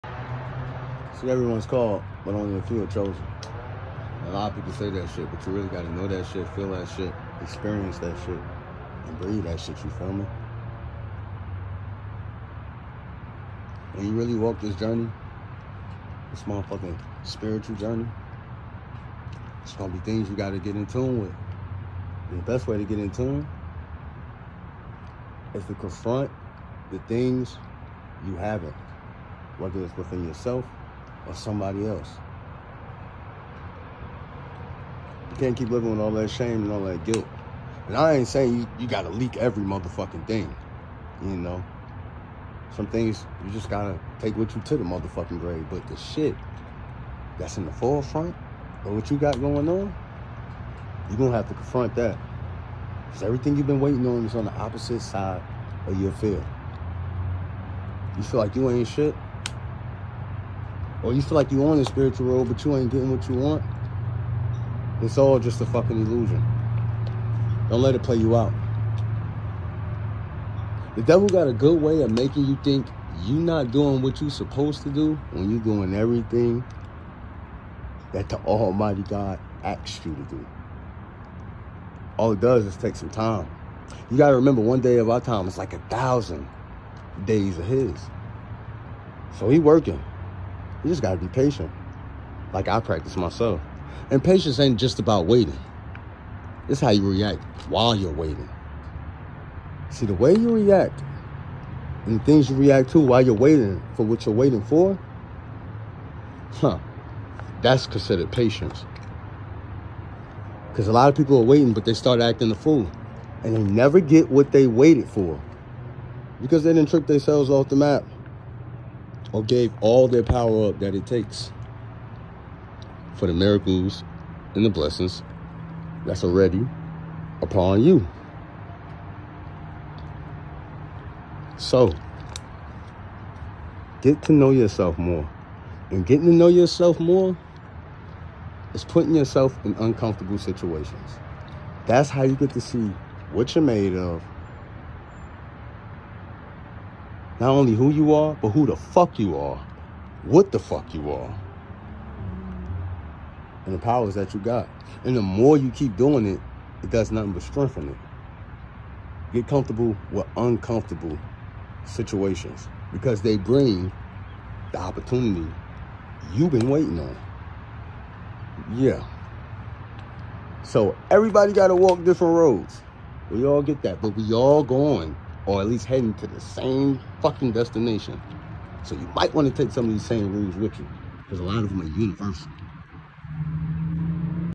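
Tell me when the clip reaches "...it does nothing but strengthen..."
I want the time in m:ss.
2:36.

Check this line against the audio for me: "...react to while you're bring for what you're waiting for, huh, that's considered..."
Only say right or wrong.
wrong.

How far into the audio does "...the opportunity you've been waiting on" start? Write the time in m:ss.
2:44.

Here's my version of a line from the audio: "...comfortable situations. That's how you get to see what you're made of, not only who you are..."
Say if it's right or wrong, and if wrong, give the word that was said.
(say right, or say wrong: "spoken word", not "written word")
wrong: "uncomfortable", not "comfortable".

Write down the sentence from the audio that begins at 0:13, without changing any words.
When you really walk this journey, this motherfucking spiritual journey, it's gonna be things you gotta get in tune with.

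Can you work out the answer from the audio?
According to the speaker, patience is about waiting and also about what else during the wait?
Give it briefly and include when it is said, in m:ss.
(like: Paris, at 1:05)
How you react, at 1:36.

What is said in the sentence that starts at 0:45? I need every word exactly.
But the shit that's in the forefront of what you got going on, you're gonna have to confront that.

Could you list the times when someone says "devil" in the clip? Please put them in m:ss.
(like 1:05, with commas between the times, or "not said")
1:11.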